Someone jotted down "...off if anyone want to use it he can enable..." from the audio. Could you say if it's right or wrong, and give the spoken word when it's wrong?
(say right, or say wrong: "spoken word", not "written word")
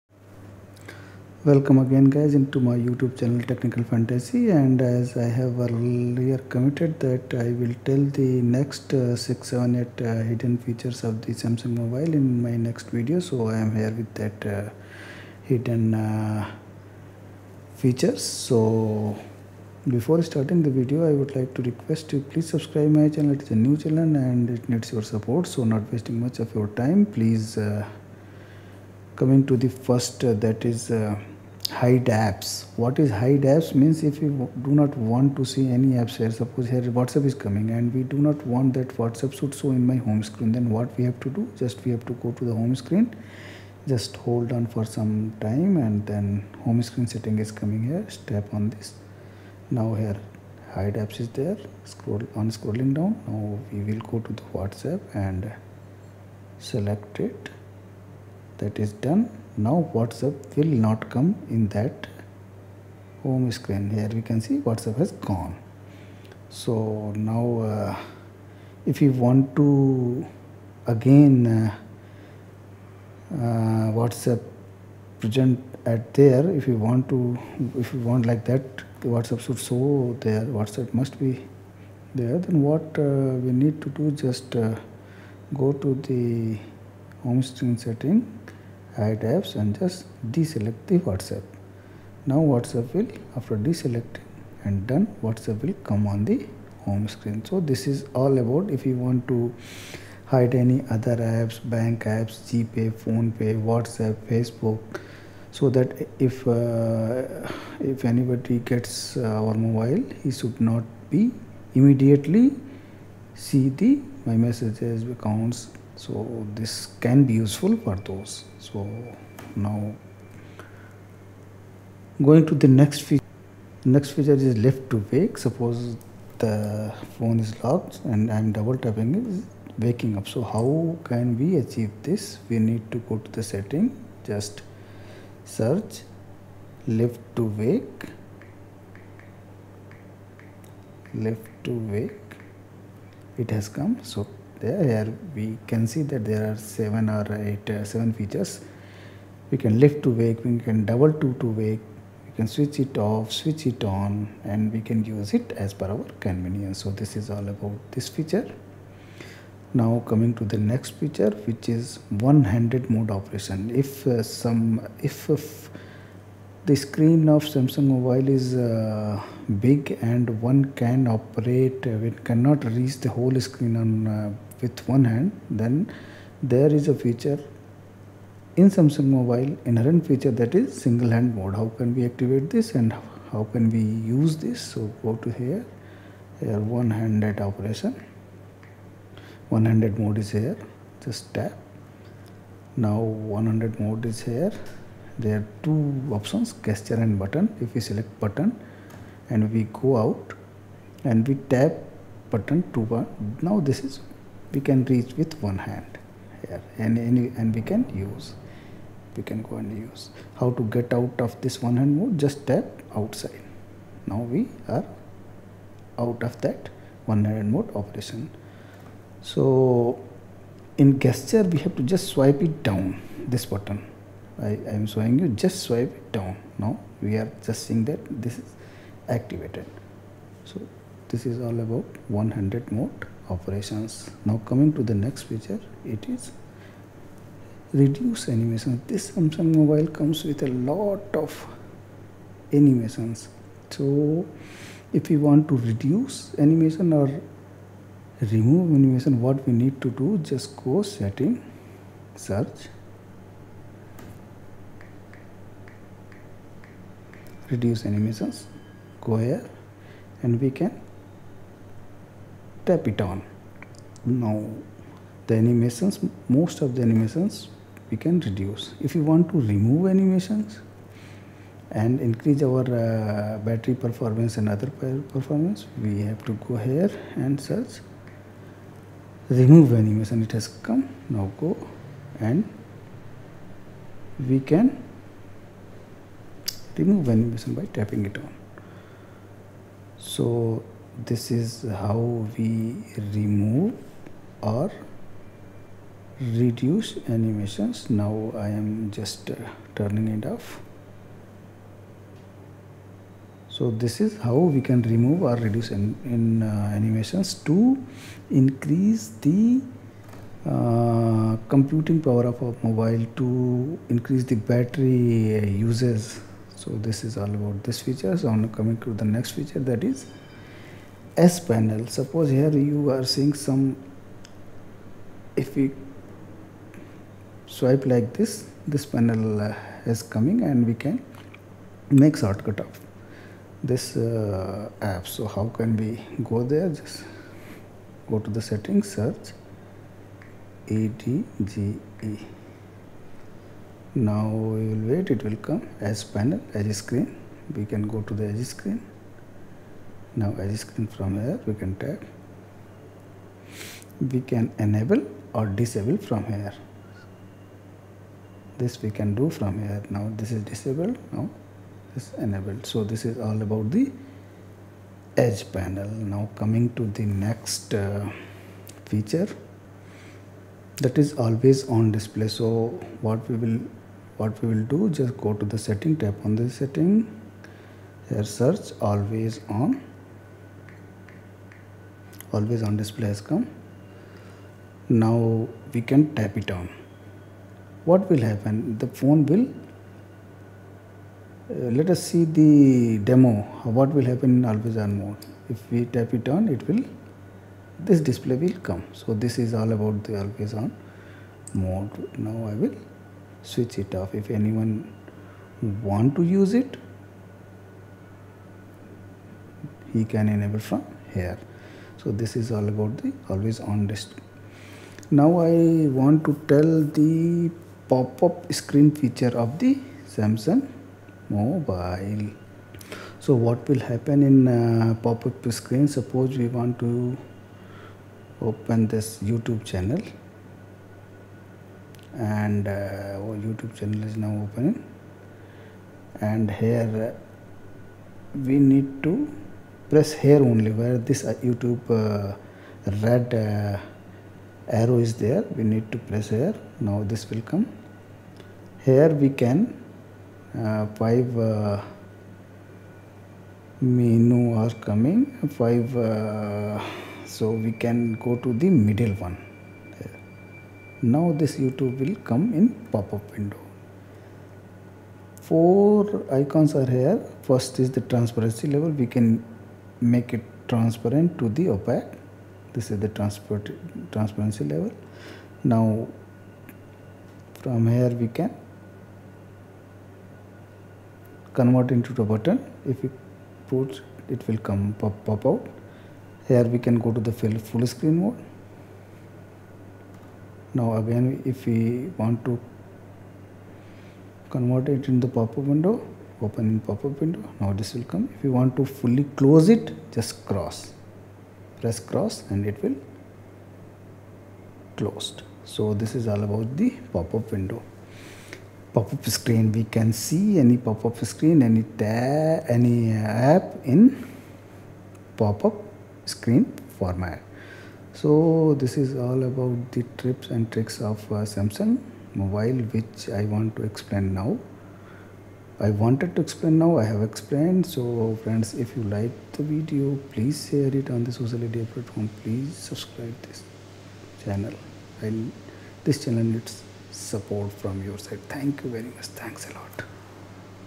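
right.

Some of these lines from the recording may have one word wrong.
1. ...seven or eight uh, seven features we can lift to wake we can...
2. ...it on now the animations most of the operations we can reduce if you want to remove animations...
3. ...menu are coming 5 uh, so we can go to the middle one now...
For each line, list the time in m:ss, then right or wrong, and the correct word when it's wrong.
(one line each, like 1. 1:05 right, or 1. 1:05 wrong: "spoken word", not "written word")
1. 2:26 right
2. 4:22 wrong: "animations", not "operations"
3. 7:33 right.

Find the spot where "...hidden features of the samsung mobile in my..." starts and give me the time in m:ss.
0:10.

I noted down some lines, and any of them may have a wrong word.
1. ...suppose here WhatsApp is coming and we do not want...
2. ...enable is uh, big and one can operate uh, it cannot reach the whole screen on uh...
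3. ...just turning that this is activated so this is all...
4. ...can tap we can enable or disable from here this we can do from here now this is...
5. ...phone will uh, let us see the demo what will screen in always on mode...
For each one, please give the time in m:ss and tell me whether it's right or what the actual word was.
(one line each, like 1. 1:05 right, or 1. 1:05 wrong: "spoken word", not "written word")
1. 0:36 right
2. 2:47 wrong: "mobile", not "enable"
3. 3:47 wrong: "seeing", not "turning"
4. 5:51 right
5. 6:28 wrong: "happen", not "screen".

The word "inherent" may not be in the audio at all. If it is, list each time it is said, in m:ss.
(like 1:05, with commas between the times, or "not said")
2:59.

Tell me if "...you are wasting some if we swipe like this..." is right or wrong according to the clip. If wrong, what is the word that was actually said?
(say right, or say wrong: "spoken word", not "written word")
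wrong: "seeing", not "wasting".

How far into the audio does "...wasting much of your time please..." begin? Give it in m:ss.
0:25.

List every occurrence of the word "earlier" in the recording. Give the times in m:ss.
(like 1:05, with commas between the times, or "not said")
0:05.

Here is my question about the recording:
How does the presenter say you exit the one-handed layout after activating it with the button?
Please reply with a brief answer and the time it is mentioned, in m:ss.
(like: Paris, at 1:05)
Tap outside, at 3:32.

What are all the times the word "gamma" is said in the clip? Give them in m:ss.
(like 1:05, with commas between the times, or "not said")
not said.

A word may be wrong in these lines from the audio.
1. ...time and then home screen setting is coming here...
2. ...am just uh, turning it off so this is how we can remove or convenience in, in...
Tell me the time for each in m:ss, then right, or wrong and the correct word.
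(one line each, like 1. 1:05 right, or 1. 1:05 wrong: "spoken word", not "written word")
1. 0:45 right
2. 4:58 wrong: "reduce", not "convenience".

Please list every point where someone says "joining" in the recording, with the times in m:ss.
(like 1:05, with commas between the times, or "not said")
not said.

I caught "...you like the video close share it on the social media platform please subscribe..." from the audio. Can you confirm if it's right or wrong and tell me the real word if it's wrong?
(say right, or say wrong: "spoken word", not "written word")
wrong: "please", not "close".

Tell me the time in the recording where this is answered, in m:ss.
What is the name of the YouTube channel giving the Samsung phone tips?
0:03.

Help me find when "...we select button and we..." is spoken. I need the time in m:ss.
3:17.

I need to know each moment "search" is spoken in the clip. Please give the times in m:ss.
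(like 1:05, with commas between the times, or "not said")
2:15, 4:12, 4:37, 5:38, 6:18.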